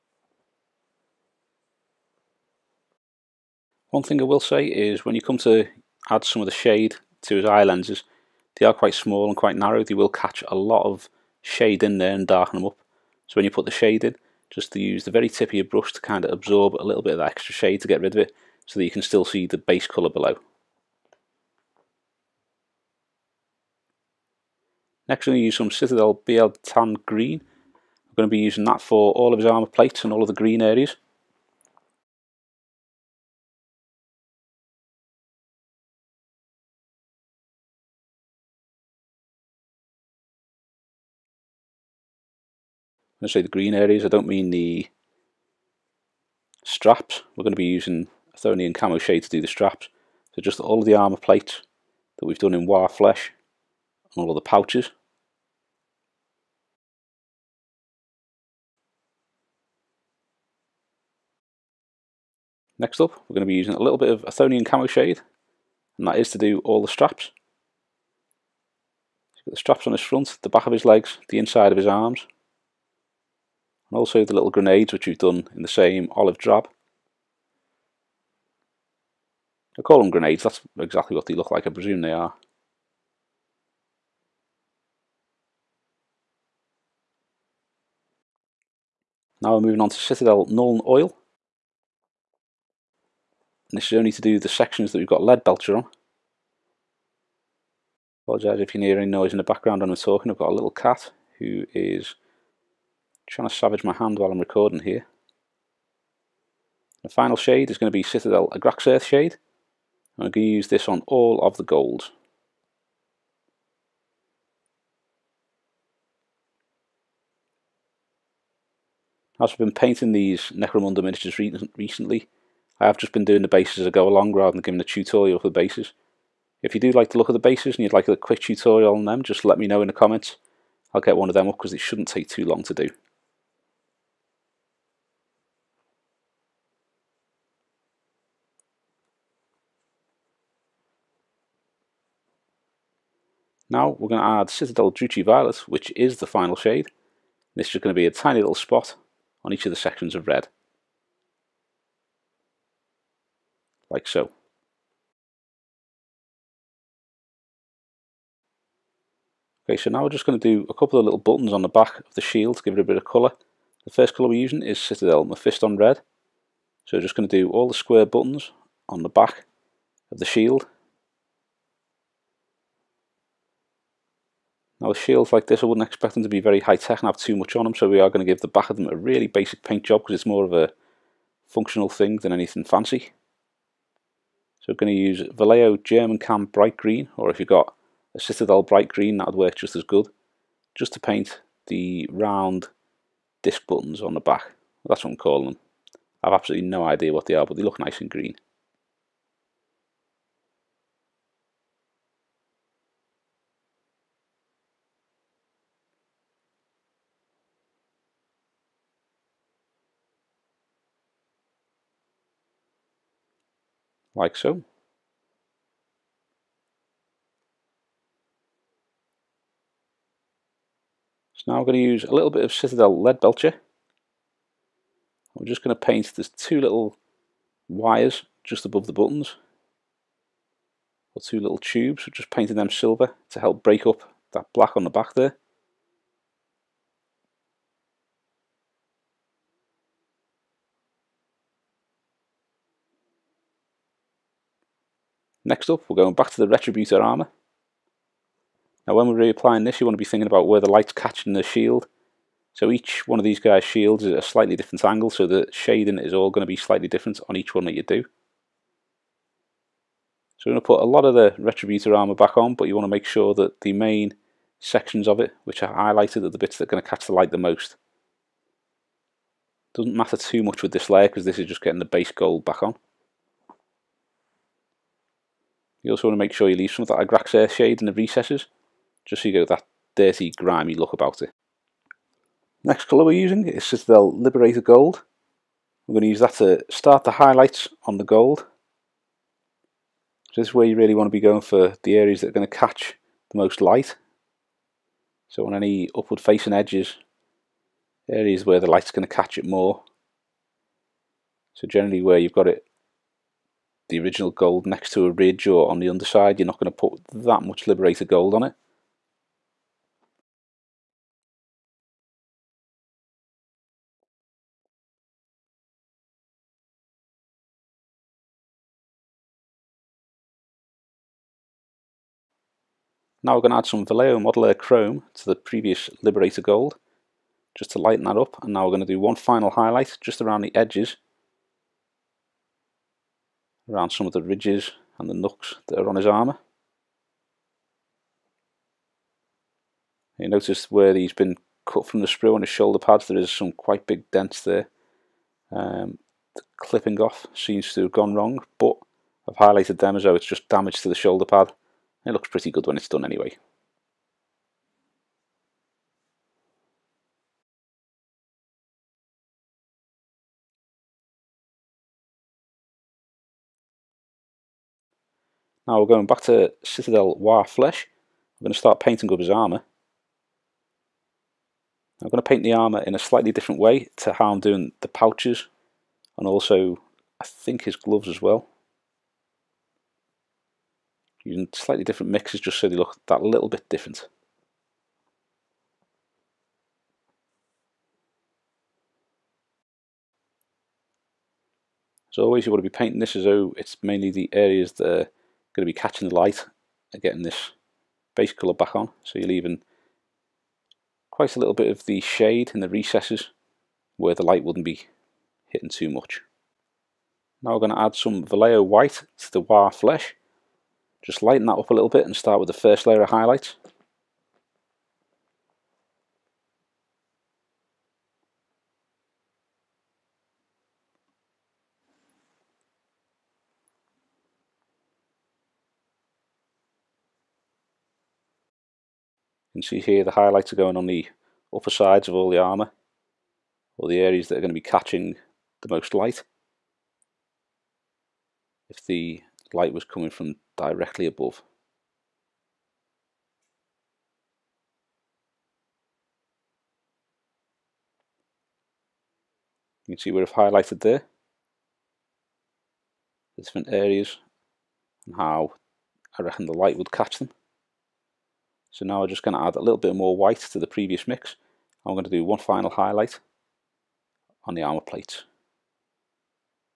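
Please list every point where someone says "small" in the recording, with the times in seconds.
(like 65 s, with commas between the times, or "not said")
8 s.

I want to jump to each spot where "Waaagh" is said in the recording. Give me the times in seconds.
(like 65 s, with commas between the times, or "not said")
52 s, 367 s, 409 s.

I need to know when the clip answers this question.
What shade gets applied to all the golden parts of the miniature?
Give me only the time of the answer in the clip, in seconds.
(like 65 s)
108 s.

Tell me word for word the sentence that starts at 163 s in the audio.
The first colour we're using is Citadel Mephiston Red.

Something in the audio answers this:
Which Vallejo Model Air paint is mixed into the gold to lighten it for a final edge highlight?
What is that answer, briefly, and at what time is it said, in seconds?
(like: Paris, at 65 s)
Chrome, at 323 s.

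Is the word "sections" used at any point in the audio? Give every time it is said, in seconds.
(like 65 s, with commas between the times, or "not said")
94 s, 149 s, 264 s.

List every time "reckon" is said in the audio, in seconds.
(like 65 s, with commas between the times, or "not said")
456 s.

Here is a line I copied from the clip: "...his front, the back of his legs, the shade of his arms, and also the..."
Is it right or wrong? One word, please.
wrong.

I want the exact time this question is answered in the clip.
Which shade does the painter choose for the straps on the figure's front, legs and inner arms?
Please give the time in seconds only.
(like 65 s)
64 s.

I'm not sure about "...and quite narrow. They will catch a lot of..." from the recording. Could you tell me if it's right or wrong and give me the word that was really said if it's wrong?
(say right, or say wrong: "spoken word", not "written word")
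right.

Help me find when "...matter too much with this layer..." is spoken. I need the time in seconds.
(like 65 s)
269 s.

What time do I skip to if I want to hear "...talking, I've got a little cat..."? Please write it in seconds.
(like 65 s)
99 s.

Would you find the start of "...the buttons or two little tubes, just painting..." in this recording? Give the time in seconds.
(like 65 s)
228 s.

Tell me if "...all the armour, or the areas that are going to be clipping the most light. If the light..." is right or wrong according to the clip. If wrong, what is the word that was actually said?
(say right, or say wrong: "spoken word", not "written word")
wrong: "catching", not "clipping".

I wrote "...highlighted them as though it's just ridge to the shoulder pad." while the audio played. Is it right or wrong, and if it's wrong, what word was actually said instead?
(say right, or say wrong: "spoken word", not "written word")
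wrong: "damage", not "ridge".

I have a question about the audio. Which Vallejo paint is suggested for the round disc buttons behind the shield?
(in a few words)
German Cam Bright Green.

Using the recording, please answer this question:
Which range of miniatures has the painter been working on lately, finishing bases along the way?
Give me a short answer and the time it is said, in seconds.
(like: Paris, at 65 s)
Necromunda, at 120 s.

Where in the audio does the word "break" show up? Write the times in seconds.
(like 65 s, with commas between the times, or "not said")
233 s.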